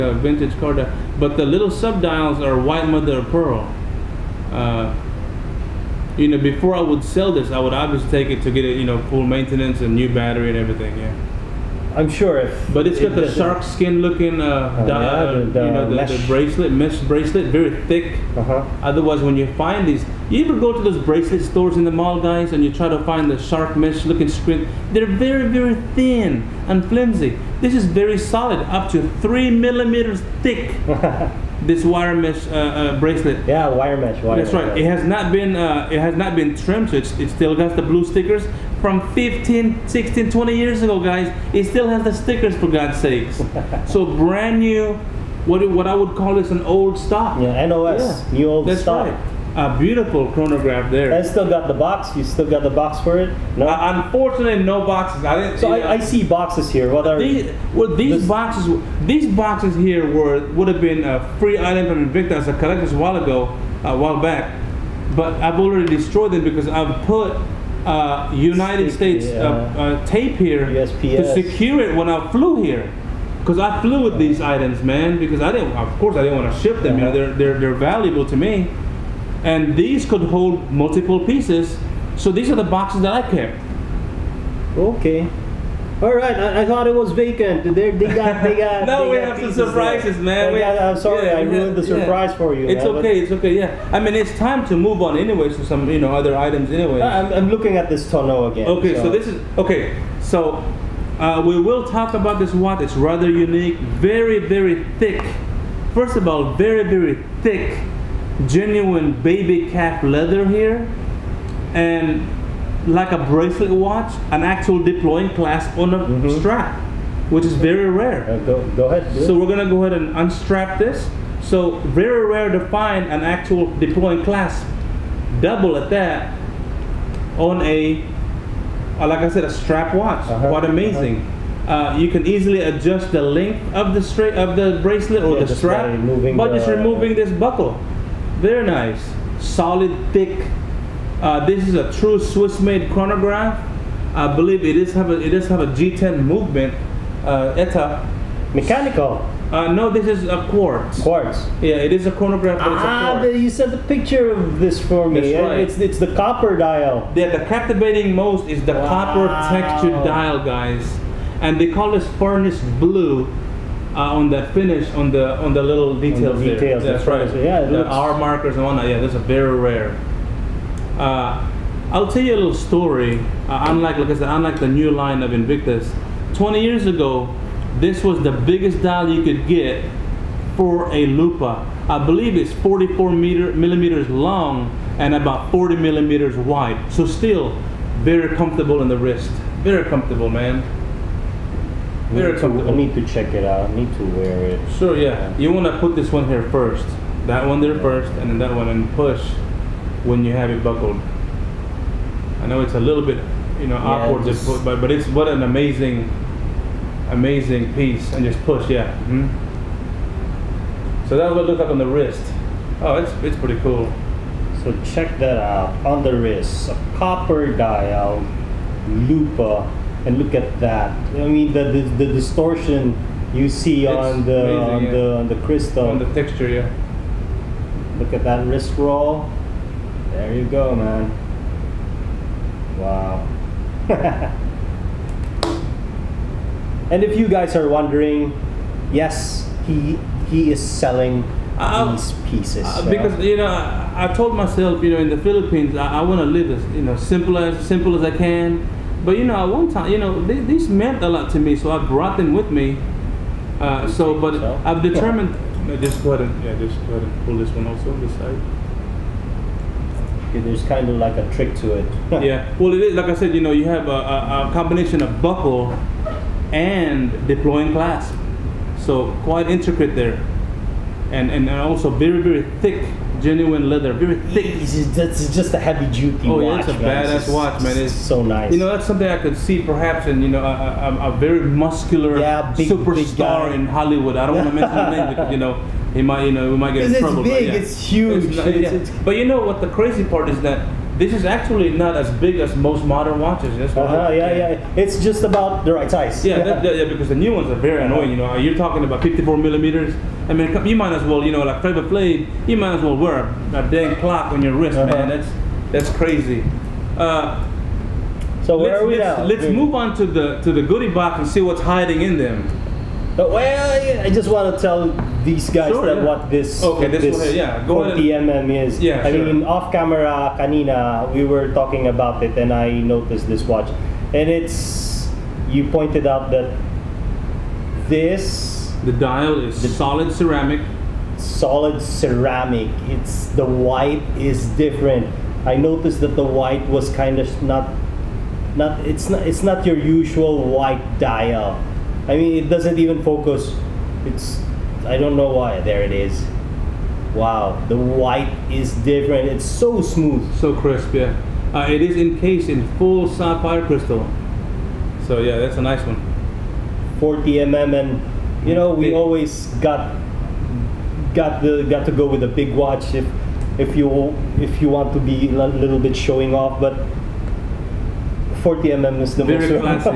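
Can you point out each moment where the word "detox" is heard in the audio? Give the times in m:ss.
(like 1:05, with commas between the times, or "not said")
not said.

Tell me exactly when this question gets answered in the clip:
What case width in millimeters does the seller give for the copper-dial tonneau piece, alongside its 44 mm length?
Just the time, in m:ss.
3:05.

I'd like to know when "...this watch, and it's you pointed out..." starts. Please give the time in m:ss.
5:23.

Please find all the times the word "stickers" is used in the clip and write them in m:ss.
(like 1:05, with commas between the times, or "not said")
0:38, 0:42.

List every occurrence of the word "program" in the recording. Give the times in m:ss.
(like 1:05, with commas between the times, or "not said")
not said.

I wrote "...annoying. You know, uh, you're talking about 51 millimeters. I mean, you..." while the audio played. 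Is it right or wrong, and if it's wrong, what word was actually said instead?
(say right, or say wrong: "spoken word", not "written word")
wrong: "54", not "51".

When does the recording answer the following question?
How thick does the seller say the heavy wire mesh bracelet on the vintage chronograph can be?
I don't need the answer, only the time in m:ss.
0:29.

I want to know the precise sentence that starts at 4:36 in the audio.
Oh watch, yeah, it's a man.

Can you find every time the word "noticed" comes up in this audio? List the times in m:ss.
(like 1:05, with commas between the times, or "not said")
5:22, 5:35.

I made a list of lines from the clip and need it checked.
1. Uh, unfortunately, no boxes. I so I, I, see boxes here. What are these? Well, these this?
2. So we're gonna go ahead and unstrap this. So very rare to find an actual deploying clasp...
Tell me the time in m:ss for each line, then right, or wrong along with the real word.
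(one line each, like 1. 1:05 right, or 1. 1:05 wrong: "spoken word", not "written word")
1. 0:53 right
2. 1:59 right.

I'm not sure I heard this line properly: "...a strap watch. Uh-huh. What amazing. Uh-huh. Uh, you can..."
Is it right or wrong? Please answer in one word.
right.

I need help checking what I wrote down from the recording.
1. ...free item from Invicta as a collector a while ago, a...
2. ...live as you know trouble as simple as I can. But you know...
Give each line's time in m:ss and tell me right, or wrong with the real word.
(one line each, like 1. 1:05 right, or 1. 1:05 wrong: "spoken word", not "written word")
1. 1:01 right
2. 4:06 wrong: "simple", not "trouble".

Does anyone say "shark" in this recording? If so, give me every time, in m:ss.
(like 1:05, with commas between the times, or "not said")
0:13, 0:23.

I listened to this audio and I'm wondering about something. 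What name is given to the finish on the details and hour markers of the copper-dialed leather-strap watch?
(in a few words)
furnace blue.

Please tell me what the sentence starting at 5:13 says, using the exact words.
But well, I just want to tell these guys sure, yeah.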